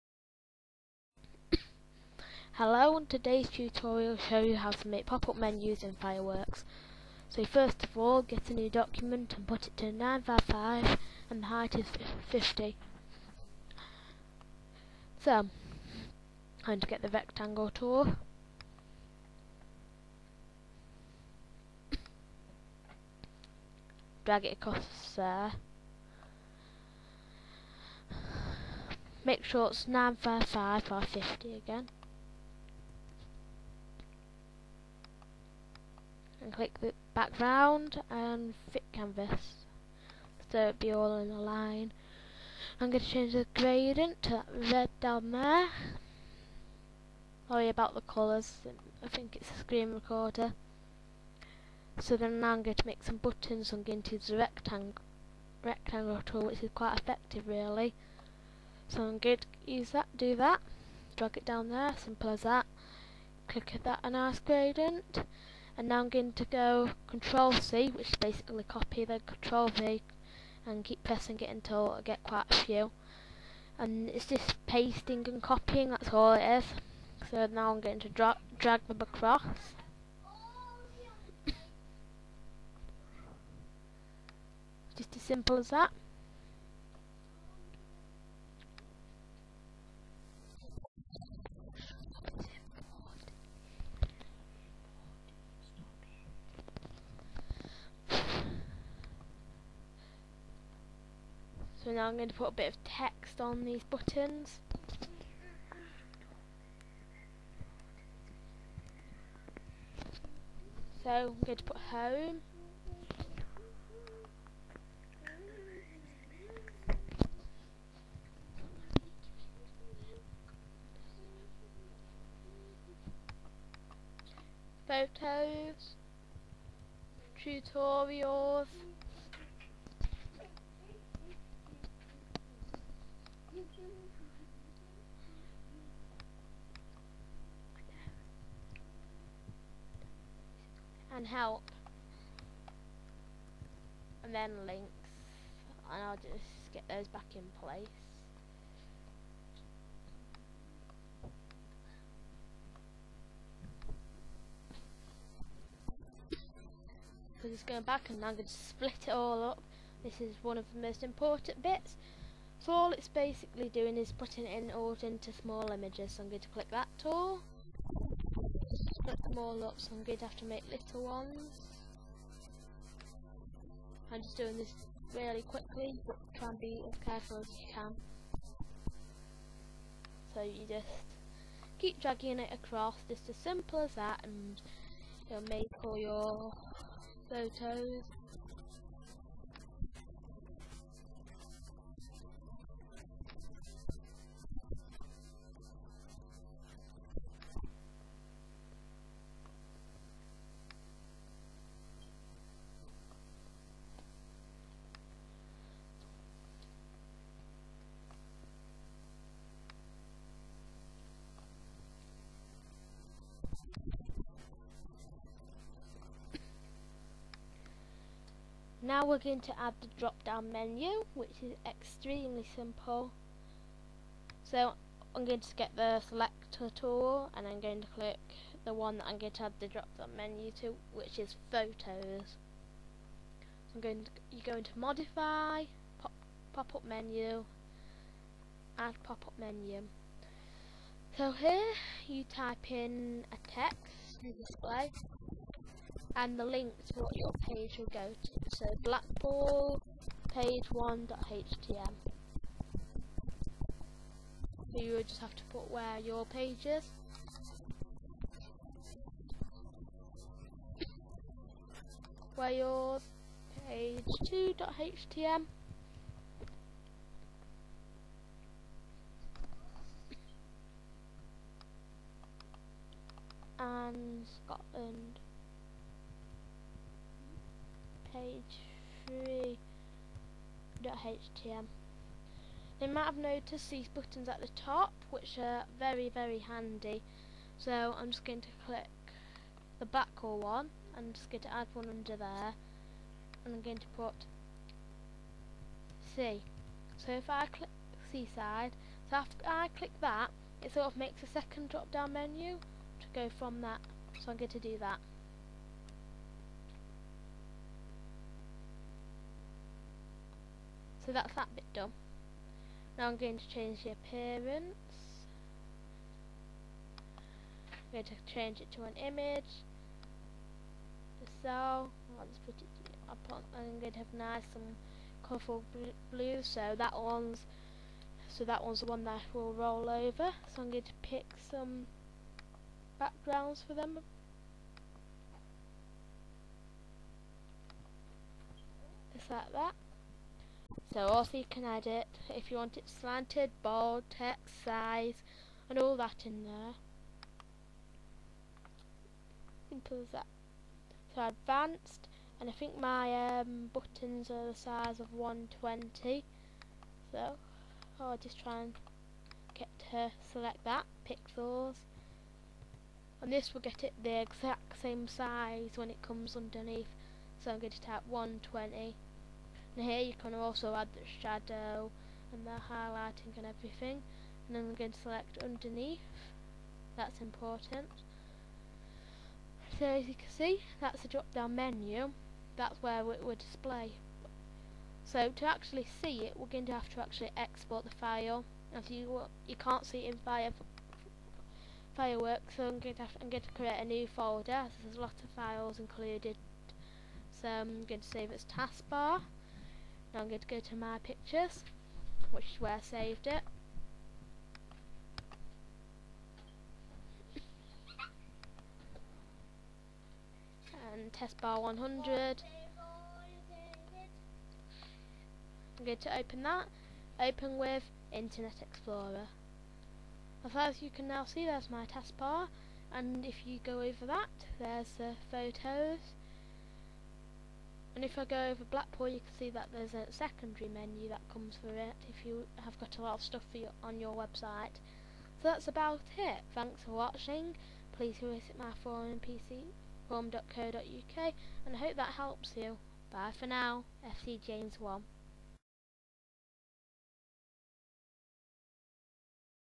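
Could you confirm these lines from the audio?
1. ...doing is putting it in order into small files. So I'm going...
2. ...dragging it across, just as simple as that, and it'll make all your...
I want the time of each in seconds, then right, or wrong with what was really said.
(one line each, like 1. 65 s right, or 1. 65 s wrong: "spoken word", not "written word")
1. 163 s wrong: "images", not "files"
2. 181 s right.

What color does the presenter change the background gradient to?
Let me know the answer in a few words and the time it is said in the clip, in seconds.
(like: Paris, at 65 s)
Red, at 44 s.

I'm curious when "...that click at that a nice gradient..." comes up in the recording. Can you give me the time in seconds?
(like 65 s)
62 s.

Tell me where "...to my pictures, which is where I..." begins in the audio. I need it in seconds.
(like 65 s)
400 s.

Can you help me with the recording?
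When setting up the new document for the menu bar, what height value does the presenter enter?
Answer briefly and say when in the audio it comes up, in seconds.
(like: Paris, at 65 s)
50, at 11 s.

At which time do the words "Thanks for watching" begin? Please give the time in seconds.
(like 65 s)
436 s.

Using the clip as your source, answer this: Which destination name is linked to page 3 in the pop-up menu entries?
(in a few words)
Scotland.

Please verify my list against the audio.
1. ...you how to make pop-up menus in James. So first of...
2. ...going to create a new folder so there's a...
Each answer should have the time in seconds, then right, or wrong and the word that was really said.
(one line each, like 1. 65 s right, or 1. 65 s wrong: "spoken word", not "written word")
1. 4 s wrong: "Fireworks", not "James"
2. 393 s right.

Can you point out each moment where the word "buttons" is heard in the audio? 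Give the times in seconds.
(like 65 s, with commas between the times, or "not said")
53 s, 103 s, 283 s, 353 s.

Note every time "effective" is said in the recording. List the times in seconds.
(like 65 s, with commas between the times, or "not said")
56 s.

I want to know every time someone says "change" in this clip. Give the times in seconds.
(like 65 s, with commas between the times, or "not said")
43 s, 313 s, 318 s.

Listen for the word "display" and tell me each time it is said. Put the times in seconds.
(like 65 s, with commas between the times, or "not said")
244 s, 383 s.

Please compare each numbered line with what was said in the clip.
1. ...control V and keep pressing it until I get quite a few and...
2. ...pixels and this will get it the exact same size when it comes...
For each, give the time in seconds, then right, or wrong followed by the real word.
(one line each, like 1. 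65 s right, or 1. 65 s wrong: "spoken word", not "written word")
1. 69 s right
2. 361 s right.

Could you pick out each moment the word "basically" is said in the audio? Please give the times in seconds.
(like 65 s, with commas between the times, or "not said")
68 s, 163 s.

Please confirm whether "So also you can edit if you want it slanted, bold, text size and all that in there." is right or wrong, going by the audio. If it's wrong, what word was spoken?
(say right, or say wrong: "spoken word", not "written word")
right.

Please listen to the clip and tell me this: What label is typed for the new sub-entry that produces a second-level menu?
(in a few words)
Seaside.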